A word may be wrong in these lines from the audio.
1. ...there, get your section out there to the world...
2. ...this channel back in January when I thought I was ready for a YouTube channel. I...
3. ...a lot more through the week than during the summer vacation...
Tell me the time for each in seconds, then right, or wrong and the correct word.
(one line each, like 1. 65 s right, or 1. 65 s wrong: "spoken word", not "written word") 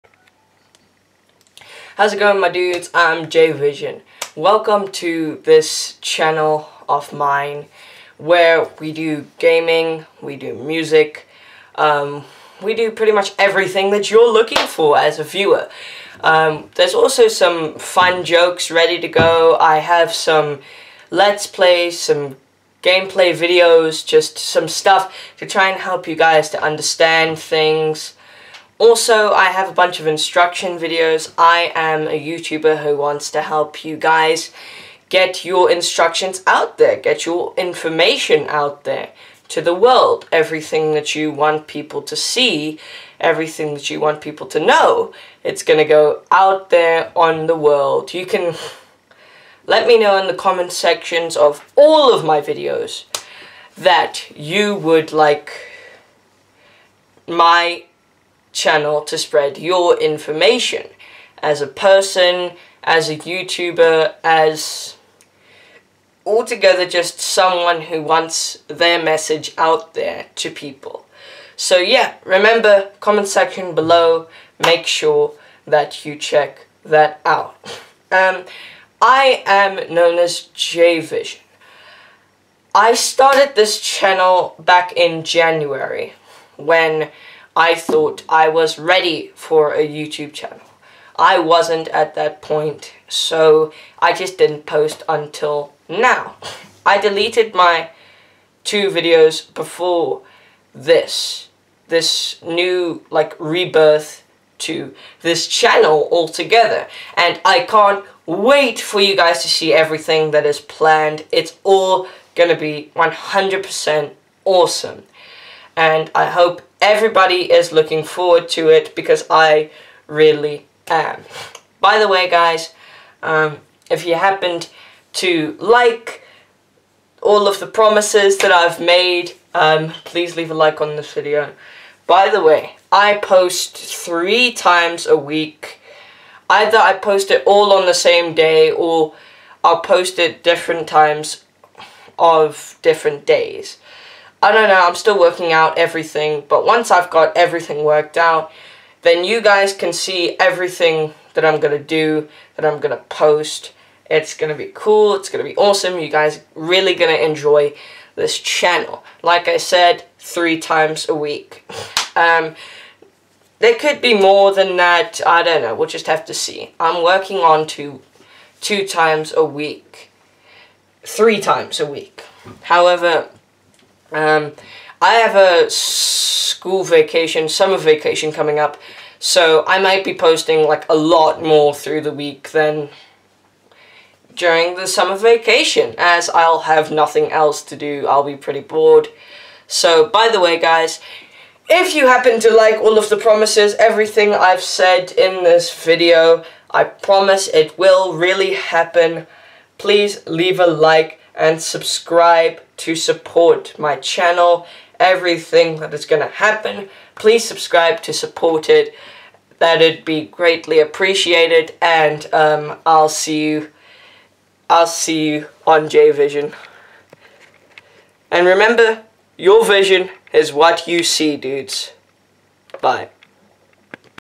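1. 36 s wrong: "information", not "section"
2. 83 s right
3. 180 s right.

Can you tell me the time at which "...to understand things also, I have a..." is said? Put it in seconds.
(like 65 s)
26 s.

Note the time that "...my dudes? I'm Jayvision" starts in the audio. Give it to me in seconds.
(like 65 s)
2 s.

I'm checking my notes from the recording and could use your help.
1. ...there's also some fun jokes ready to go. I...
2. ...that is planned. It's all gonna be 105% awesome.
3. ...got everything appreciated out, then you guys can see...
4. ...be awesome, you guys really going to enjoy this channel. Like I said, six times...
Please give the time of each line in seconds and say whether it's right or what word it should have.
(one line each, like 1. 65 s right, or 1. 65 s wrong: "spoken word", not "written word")
1. 16 s right
2. 110 s wrong: "100", not "105"
3. 147 s wrong: "worked", not "appreciated"
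4. 155 s wrong: "three", not "six".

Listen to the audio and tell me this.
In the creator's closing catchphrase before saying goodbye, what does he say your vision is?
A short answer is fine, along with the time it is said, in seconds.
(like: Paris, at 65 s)
What you see, at 220 s.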